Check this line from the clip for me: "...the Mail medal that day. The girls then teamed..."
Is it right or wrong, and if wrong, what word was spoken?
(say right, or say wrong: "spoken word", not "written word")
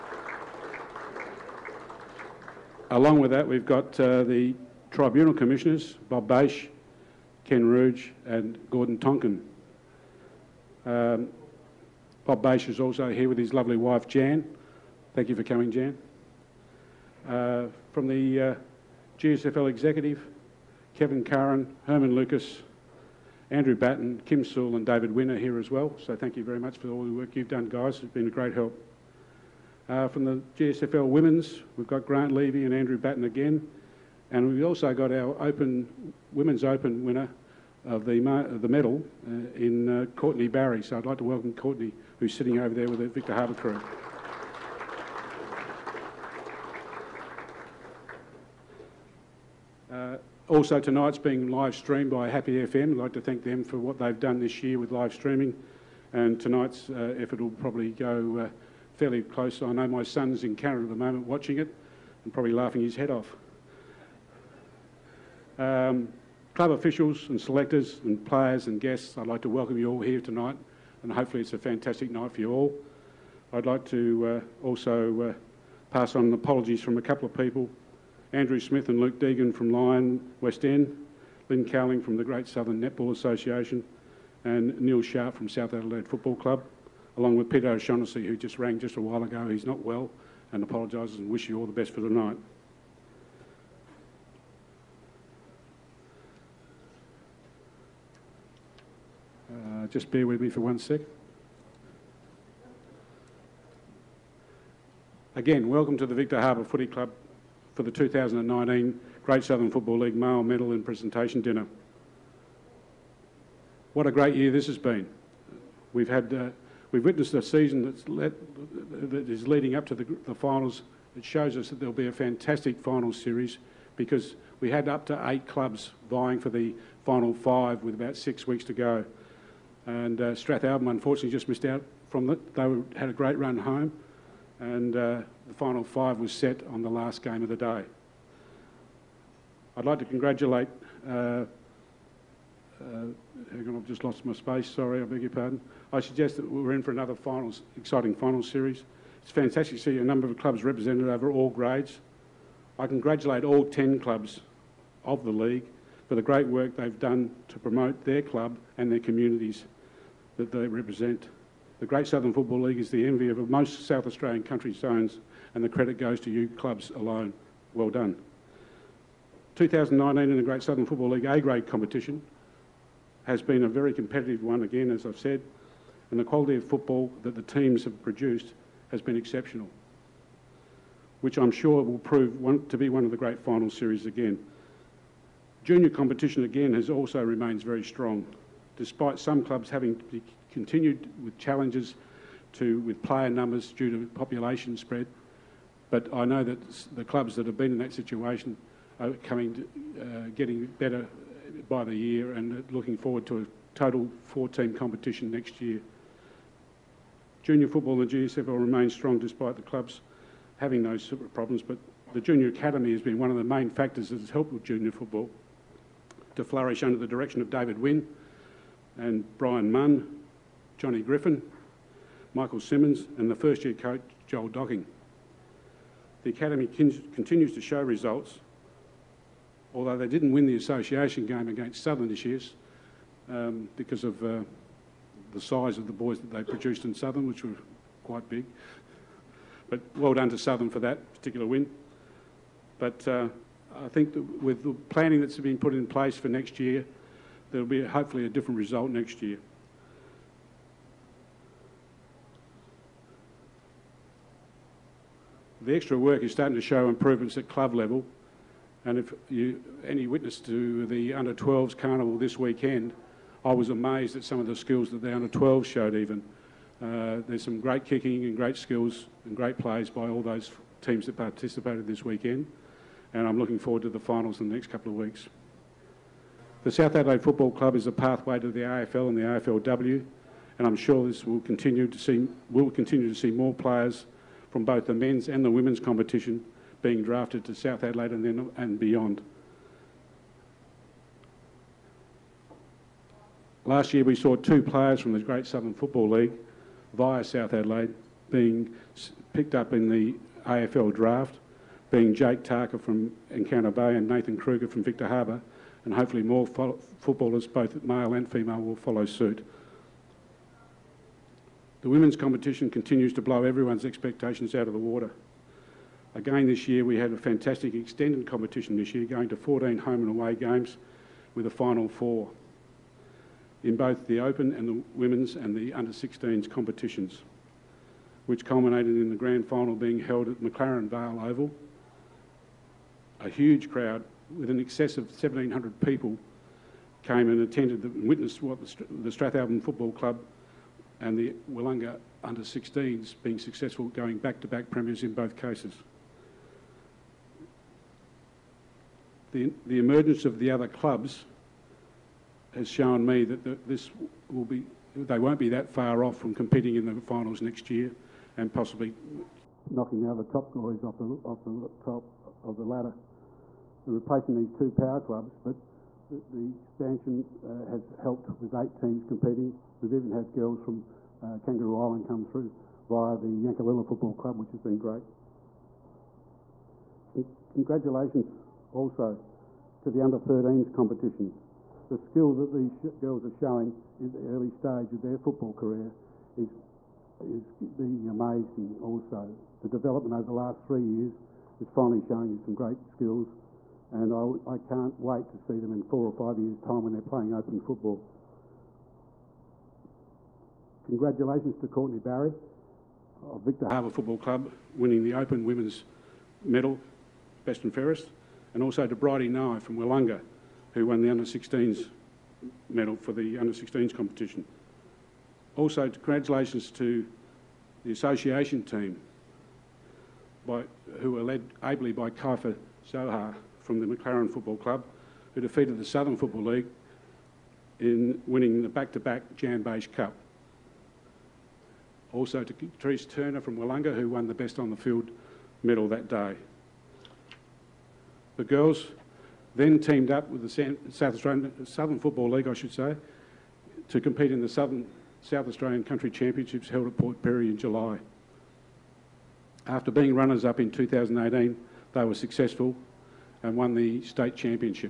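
wrong: "Field", not "Mail".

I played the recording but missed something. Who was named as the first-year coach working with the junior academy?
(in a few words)
Joel Docking.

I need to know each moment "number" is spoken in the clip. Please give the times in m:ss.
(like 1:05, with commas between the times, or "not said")
2:30, 3:13.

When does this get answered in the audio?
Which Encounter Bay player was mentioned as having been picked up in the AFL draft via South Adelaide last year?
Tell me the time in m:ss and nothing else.
5:02.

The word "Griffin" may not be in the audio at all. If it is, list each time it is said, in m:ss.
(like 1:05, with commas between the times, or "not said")
3:41.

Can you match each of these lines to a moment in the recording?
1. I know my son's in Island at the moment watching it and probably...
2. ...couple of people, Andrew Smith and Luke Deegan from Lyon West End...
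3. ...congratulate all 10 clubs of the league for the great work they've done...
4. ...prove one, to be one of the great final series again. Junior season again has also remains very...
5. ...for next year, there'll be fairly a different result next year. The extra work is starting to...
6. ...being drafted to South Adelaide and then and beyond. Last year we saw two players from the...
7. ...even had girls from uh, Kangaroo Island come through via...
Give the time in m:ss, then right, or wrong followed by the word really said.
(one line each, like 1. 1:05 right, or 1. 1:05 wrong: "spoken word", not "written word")
1. 0:59 wrong: "Canada", not "Island"
2. 1:17 right
3. 2:32 right
4. 3:01 wrong: "competition", not "season"
5. 4:06 wrong: "hopefully", not "fairly"
6. 4:46 right
7. 6:09 right.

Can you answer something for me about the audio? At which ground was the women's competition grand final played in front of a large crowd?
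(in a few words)
McLaren Vale Oval.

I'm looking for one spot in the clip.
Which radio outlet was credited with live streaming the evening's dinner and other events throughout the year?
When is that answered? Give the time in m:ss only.
0:52.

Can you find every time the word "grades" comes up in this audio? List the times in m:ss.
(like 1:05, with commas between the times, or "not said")
2:31, 2:51.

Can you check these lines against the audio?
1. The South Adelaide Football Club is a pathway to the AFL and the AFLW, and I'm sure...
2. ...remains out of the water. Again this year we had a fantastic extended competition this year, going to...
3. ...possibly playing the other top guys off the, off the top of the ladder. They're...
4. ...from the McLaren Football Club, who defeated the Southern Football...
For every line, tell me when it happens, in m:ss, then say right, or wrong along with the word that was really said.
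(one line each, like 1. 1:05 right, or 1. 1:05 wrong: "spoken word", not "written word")
1. 4:36 right
2. 5:13 wrong: "expectations", not "remains"
3. 5:58 wrong: "knocking", not "playing"
4. 7:03 right.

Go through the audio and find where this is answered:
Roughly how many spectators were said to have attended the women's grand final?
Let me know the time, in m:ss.
5:35.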